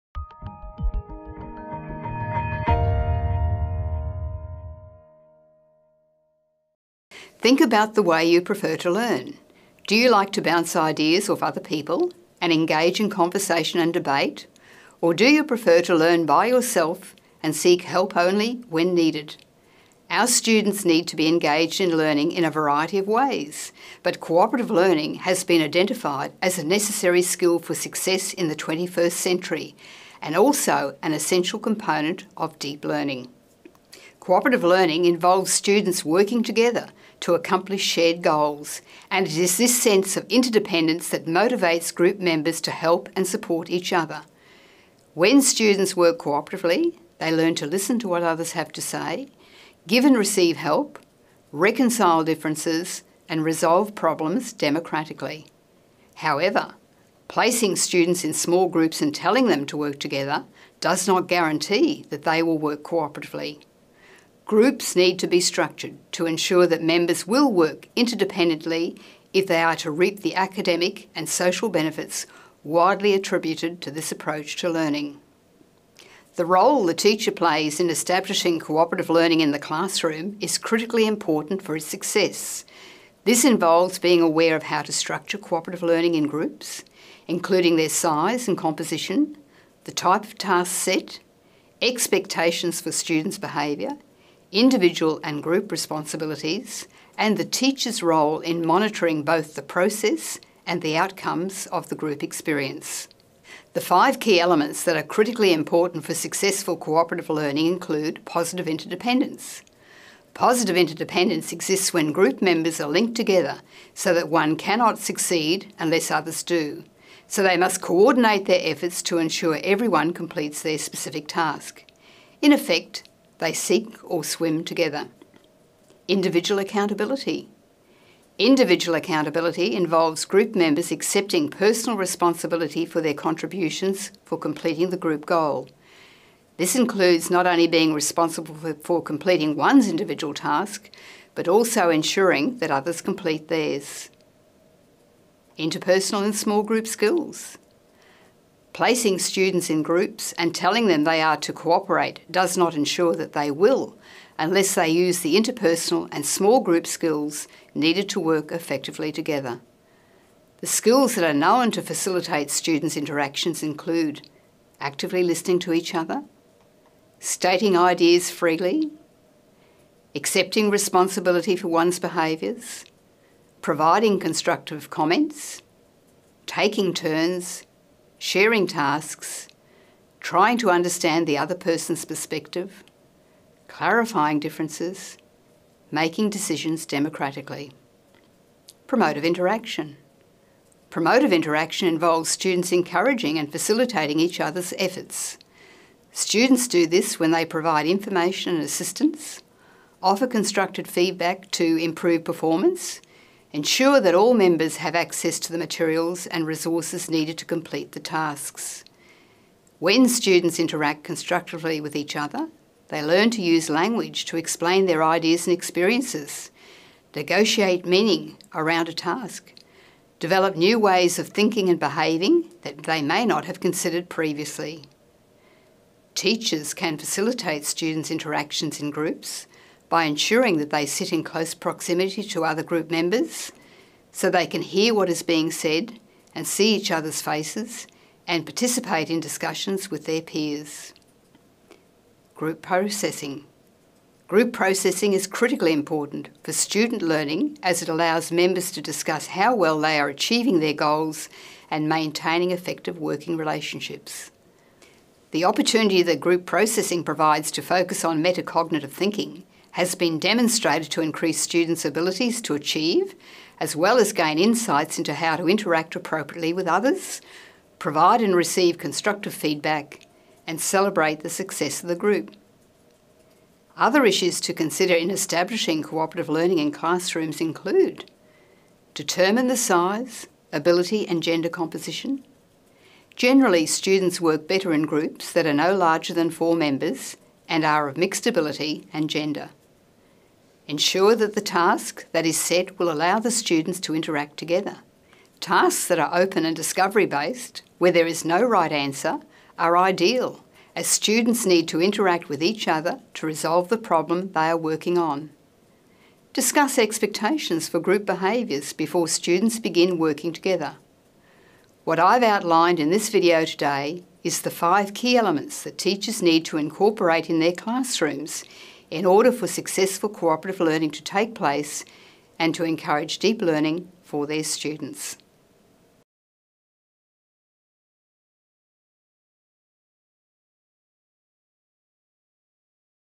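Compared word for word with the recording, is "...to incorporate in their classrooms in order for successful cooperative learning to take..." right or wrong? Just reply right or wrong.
right.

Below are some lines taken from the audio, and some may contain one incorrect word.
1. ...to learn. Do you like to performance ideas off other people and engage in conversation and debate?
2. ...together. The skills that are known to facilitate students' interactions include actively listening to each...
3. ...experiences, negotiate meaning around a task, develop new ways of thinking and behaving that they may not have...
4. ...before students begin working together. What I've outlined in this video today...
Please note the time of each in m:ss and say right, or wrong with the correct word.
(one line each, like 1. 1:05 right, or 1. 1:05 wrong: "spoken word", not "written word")
1. 0:08 wrong: "bounce", not "performance"
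2. 2:39 right
3. 3:35 right
4. 5:08 right.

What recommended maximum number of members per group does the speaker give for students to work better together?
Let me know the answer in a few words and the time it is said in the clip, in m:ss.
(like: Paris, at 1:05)
4, at 4:46.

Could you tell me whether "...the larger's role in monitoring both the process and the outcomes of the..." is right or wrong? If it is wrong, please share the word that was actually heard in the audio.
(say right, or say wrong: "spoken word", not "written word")
wrong: "teacher", not "larger".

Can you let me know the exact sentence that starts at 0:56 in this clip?
However, placing students in small groups and telling them to work together does not guarantee that they will work cooperatively.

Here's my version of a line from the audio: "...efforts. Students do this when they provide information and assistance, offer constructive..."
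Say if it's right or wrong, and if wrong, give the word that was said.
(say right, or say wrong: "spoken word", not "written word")
right.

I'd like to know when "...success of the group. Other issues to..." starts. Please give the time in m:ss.
4:31.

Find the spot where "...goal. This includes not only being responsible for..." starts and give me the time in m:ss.
2:15.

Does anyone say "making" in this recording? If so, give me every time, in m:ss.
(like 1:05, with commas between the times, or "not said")
3:05.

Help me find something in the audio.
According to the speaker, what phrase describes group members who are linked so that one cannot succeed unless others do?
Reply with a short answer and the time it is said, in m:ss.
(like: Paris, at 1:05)
sink or swim together, at 2:03.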